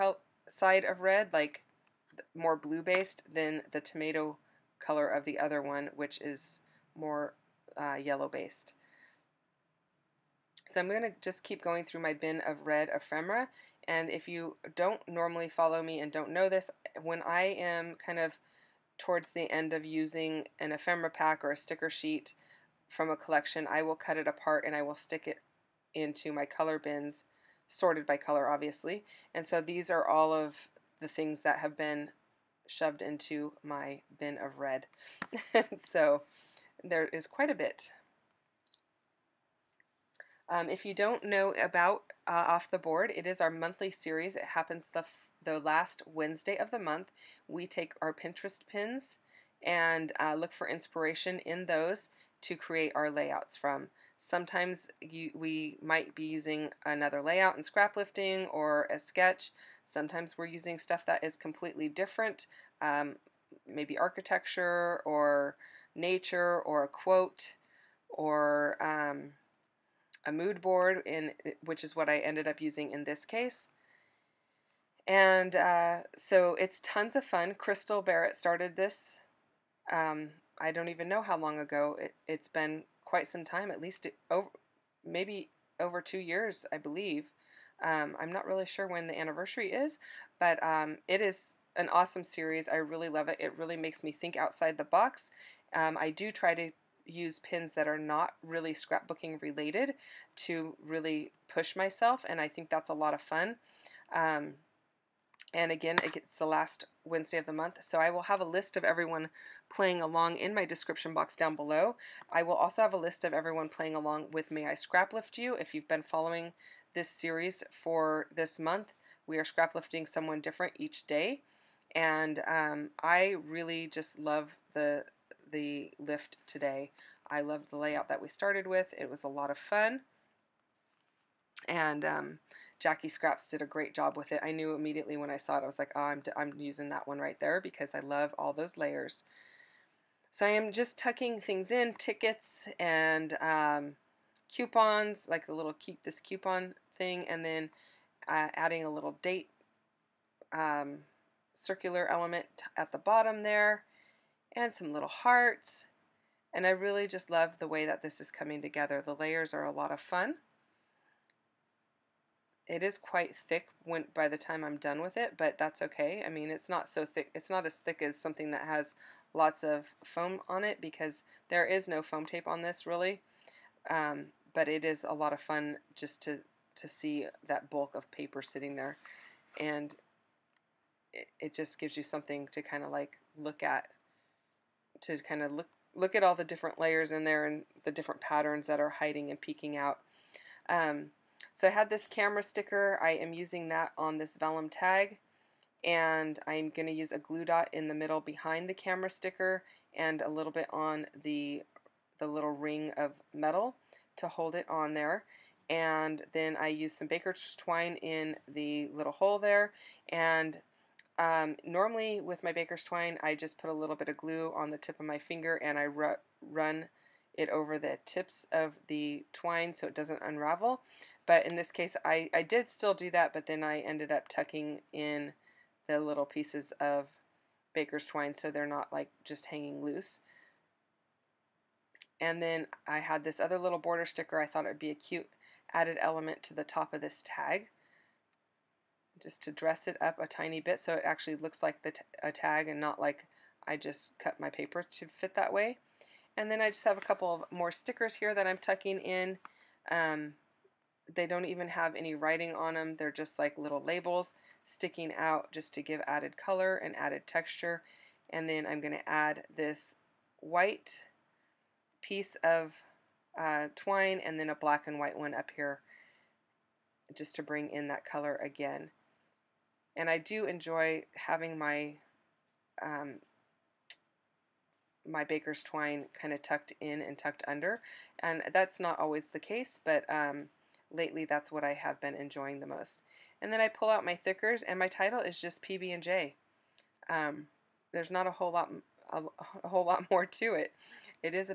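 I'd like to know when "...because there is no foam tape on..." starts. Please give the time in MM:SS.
02:50.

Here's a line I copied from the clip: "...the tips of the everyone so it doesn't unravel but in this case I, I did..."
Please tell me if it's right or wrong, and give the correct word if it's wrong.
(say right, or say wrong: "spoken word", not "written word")
wrong: "twine", not "everyone".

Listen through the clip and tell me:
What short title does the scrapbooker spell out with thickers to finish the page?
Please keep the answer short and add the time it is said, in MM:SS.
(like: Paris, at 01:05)
PB&J, at 04:45.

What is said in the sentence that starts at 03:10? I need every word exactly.
Um, so I had this camera sticker.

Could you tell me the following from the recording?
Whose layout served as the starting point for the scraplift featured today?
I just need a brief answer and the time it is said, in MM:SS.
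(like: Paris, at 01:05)
Jackie Scraps, at 02:12.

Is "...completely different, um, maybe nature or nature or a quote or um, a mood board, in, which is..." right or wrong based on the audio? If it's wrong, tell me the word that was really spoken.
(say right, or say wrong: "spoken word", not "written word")
wrong: "architecture", not "nature".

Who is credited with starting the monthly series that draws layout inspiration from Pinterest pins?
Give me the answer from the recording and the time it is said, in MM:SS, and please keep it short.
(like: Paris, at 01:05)
Crystal Barrett, at 01:17.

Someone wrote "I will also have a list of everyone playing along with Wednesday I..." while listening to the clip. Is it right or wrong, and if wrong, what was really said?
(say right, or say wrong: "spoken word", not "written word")
wrong: "May", not "Wednesday".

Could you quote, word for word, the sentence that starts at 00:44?
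It happens the, the last Wednesday of the month.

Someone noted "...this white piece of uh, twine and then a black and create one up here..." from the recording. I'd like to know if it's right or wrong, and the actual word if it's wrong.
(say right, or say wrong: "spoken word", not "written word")
wrong: "white", not "create".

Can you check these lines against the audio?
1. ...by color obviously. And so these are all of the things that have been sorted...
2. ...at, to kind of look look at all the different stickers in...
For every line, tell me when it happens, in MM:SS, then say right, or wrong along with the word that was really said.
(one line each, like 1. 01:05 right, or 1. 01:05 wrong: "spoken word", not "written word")
1. 00:28 wrong: "shoved", not "sorted"
2. 03:03 wrong: "layers", not "stickers".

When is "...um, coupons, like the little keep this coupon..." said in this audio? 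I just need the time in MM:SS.
02:23.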